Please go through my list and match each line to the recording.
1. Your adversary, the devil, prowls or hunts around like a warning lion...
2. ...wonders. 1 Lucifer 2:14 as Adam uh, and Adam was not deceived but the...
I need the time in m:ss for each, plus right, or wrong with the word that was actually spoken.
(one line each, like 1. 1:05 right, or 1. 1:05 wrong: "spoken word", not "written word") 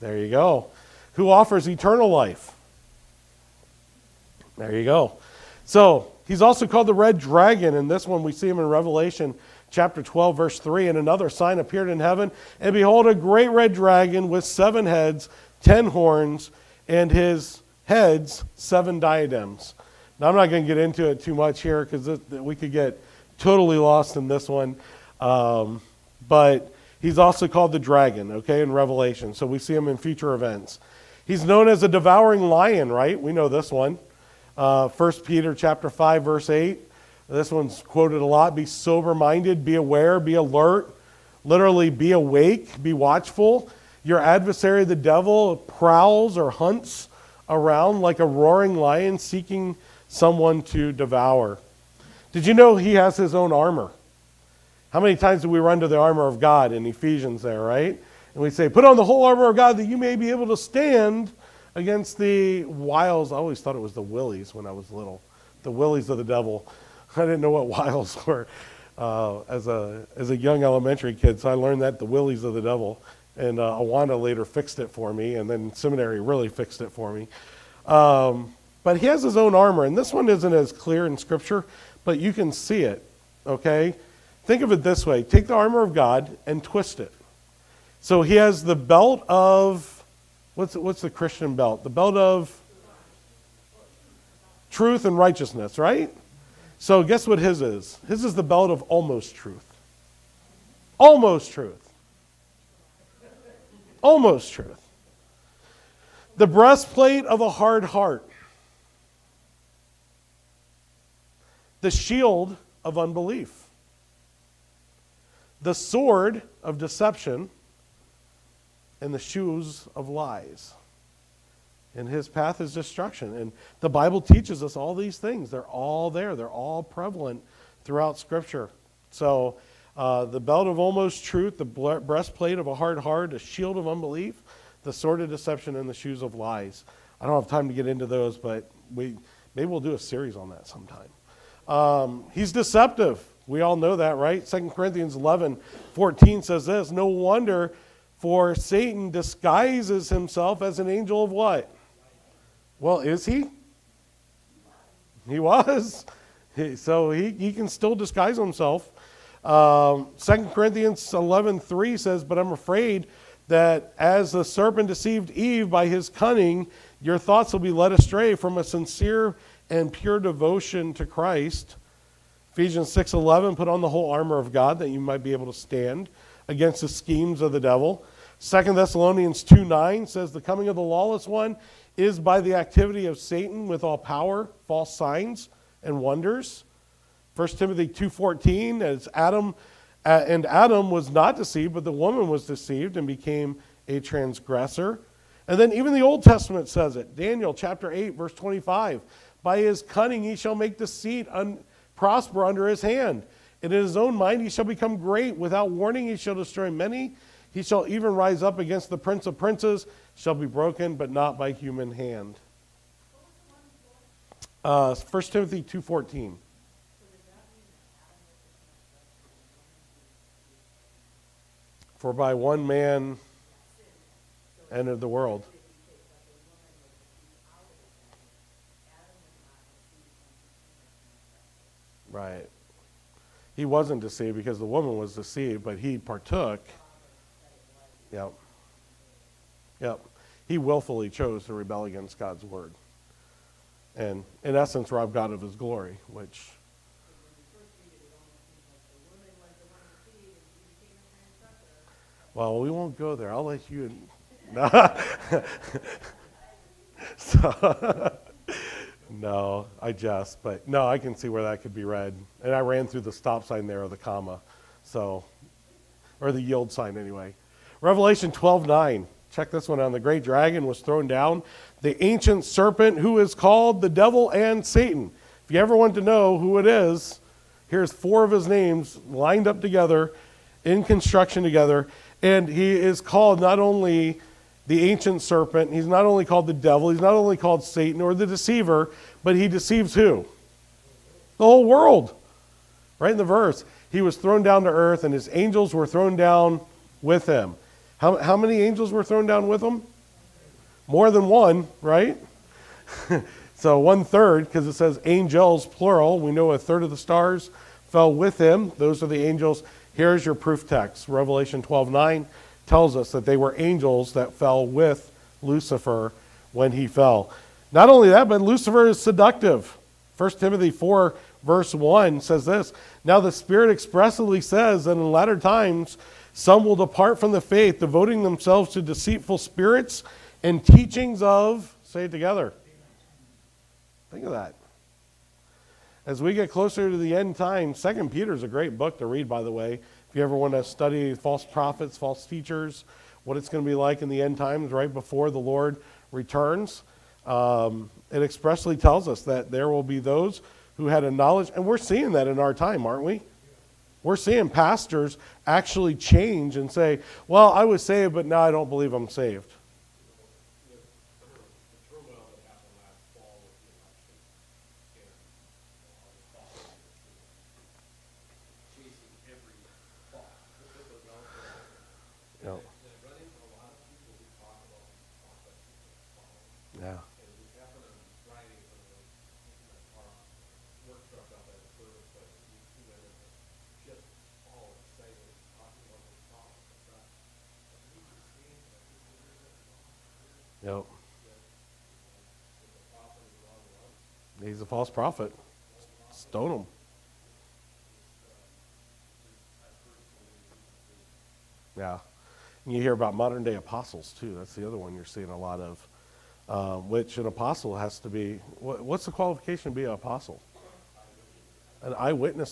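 1. 0:44 wrong: "roaring", not "warning"
2. 3:05 wrong: "Timothy", not "Lucifer".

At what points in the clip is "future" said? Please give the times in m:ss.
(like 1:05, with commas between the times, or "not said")
0:29.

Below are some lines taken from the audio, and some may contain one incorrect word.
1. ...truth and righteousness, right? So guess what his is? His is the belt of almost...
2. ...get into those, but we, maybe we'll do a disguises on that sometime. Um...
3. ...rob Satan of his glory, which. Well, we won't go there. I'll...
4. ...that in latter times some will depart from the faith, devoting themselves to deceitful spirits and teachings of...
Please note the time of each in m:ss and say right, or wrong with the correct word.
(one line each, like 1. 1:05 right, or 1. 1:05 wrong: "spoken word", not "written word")
1. 1:34 right
2. 2:17 wrong: "series", not "disguises"
3. 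4:04 wrong: "God", not "Satan"
4. 5:24 right.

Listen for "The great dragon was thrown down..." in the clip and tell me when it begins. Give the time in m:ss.
4:29.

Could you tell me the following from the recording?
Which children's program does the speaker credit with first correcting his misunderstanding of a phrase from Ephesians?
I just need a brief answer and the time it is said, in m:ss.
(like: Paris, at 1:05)
Awana, at 1:13.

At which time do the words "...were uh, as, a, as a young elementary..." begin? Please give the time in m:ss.
1:08.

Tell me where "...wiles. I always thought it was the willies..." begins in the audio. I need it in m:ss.
1:02.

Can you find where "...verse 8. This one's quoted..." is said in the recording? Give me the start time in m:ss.
0:36.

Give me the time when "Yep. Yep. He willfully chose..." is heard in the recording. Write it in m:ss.
3:58.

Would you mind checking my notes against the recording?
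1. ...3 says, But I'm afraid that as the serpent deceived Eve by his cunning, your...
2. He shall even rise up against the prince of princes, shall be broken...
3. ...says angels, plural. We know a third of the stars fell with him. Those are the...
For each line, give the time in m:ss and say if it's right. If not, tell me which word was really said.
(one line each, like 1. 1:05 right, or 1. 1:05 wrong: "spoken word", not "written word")
1. 2:41 right
2. 3:27 right
3. 5:04 right.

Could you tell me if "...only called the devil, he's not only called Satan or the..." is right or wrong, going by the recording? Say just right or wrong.
right.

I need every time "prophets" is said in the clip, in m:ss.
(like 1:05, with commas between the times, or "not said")
5:41, 6:34.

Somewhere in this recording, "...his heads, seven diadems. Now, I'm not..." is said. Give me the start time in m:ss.
0:17.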